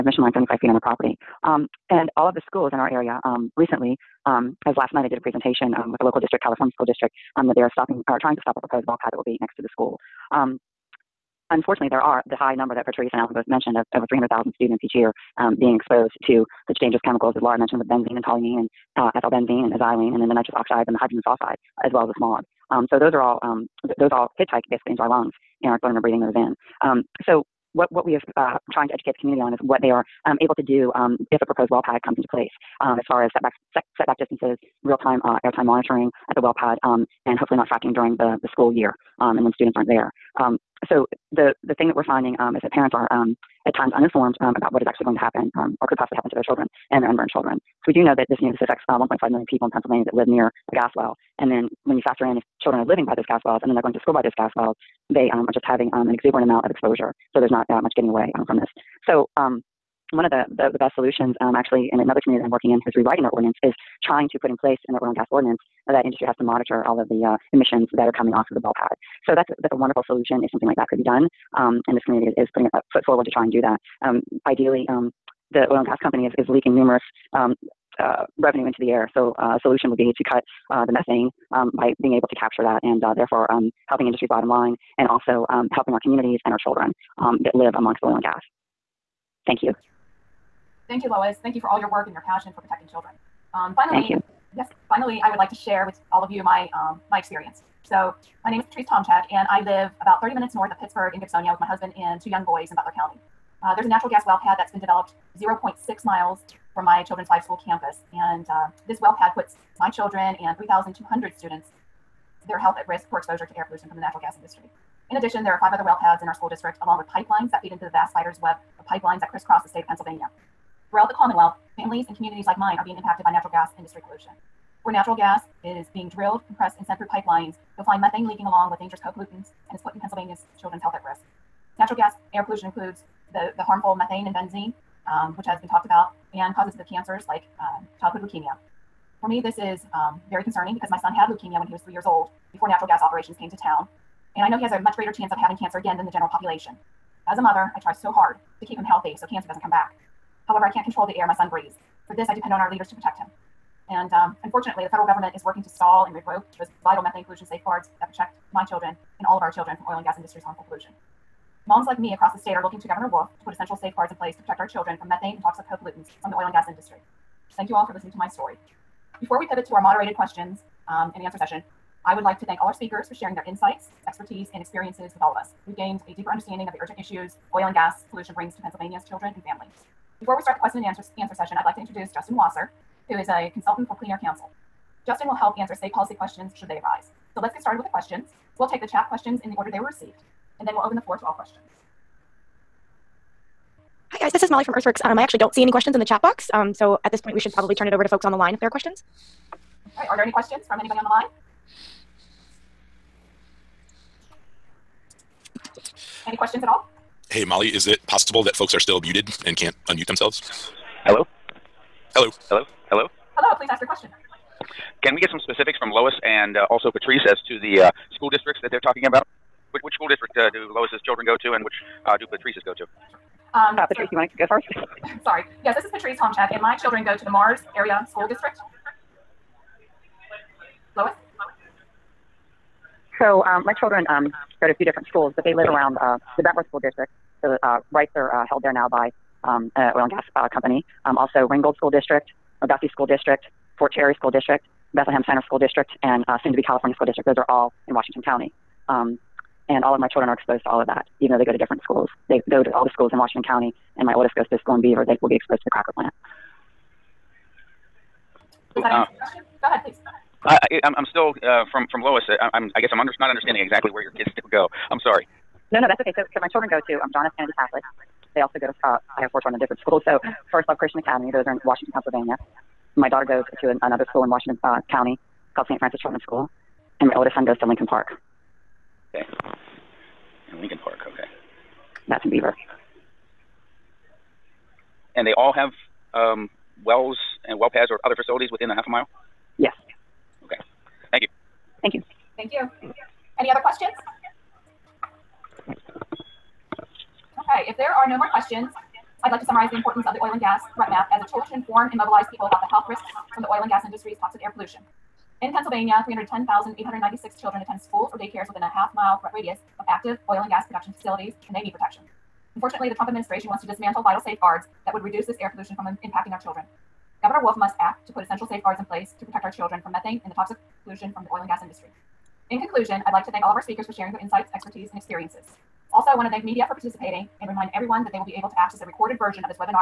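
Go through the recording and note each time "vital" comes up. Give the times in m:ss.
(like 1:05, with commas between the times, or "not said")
2:36, 5:14.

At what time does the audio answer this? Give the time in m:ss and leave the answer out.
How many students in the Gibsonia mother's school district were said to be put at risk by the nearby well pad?
1:50.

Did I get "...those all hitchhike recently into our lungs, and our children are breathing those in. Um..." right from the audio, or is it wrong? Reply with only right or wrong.
wrong.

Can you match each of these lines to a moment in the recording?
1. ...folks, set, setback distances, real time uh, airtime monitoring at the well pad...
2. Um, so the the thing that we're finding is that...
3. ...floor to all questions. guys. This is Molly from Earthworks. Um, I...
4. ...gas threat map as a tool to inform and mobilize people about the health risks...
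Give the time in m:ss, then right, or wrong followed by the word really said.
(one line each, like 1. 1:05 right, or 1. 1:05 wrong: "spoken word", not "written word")
1. 0:33 wrong: "setbacks", not "folks"
2. 0:40 right
3. 3:11 right
4. 5:00 right.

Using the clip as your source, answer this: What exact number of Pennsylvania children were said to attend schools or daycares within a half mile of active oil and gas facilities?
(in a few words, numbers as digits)
310,896.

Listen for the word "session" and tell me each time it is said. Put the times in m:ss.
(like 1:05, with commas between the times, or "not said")
2:51, 3:01.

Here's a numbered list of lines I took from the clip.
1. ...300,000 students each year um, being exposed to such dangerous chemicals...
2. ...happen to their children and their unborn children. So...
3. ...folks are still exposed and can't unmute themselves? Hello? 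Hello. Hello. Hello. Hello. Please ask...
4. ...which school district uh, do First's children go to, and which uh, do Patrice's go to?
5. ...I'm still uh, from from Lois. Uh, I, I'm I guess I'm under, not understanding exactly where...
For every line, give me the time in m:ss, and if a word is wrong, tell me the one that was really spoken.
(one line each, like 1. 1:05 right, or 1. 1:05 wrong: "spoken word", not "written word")
1. 0:14 right
2. 0:46 right
3. 3:28 wrong: "muted", not "exposed"
4. 3:39 wrong: "Lois", not "First"
5. 4:20 right.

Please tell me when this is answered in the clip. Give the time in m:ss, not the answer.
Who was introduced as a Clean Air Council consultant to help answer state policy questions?
3:02.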